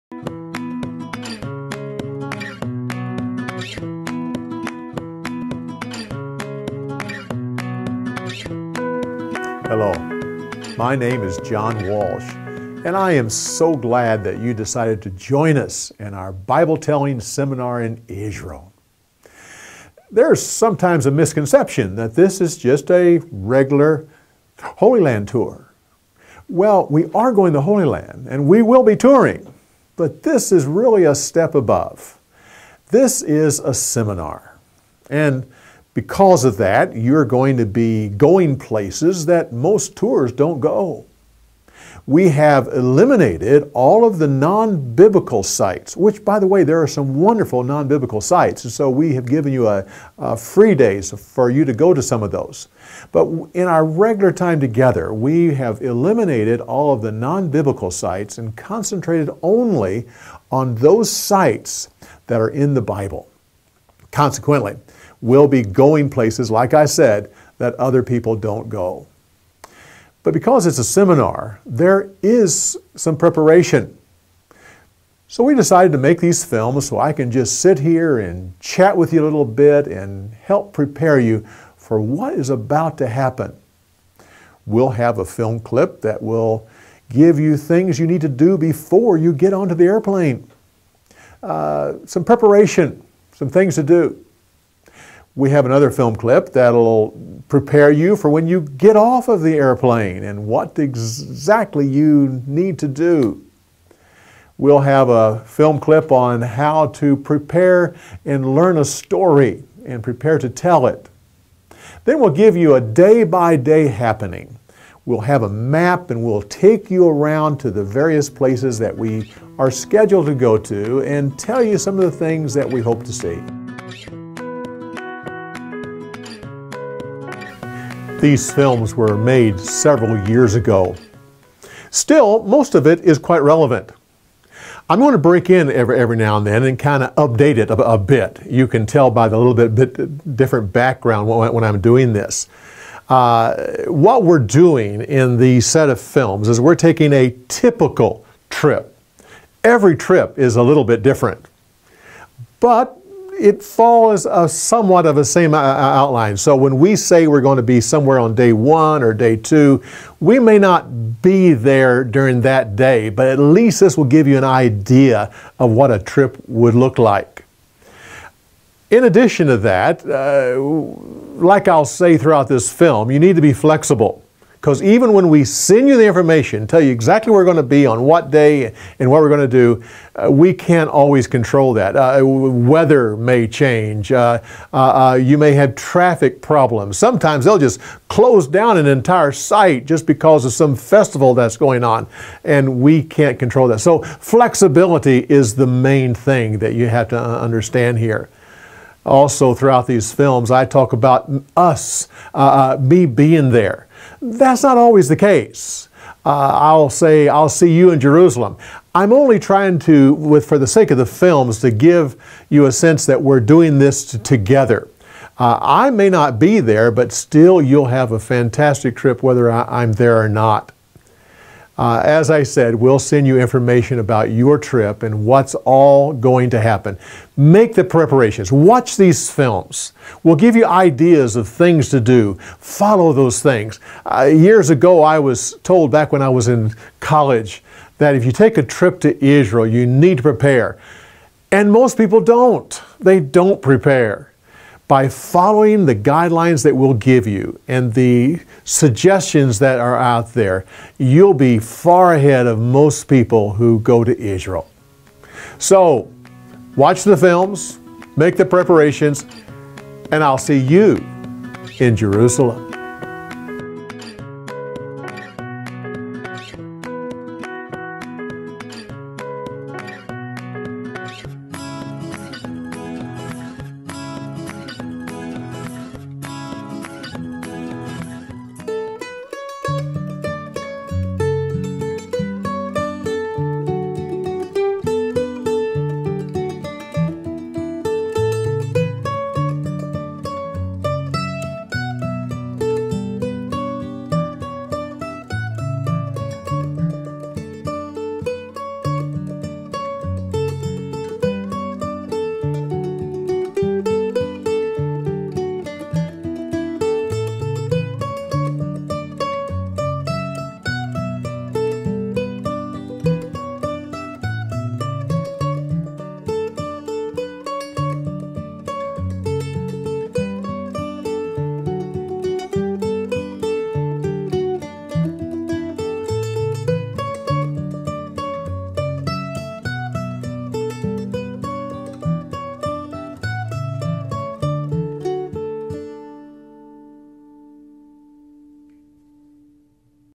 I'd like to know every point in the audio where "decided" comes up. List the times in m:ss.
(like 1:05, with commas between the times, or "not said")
0:14, 1:15.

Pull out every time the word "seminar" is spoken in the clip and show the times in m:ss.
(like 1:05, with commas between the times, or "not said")
0:17, 0:33, 1:10.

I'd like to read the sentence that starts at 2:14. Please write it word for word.
I'm going to break in every, every now and then and kind of update it a, a bit.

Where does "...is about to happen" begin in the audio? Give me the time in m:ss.
1:22.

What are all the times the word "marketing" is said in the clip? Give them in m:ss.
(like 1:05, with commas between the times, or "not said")
not said.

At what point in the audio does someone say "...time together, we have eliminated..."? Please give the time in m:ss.
0:54.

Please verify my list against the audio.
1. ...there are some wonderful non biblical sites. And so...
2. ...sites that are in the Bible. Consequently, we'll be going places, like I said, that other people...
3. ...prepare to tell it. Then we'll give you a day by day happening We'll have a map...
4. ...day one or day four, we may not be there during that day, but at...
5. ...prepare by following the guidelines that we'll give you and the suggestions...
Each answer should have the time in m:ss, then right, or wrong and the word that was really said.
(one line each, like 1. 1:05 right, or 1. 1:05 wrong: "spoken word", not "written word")
1. 0:46 right
2. 1:01 right
3. 1:50 right
4. 2:38 wrong: "two", not "four"
5. 4:03 right.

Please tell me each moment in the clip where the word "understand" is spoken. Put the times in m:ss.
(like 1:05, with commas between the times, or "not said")
3:17.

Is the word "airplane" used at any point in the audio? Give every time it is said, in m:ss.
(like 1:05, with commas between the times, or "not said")
1:29, 1:39.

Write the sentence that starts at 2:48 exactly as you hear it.
In addition to that, uh, like I'll say throughout this film, you need to be flexible.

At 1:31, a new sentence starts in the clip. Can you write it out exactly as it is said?
Uh, some preparation some things to do.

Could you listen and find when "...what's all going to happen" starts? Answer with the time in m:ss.
3:45.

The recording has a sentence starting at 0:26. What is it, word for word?
Well, we are going to Holy Land, and we will be touring, but this is really a step above.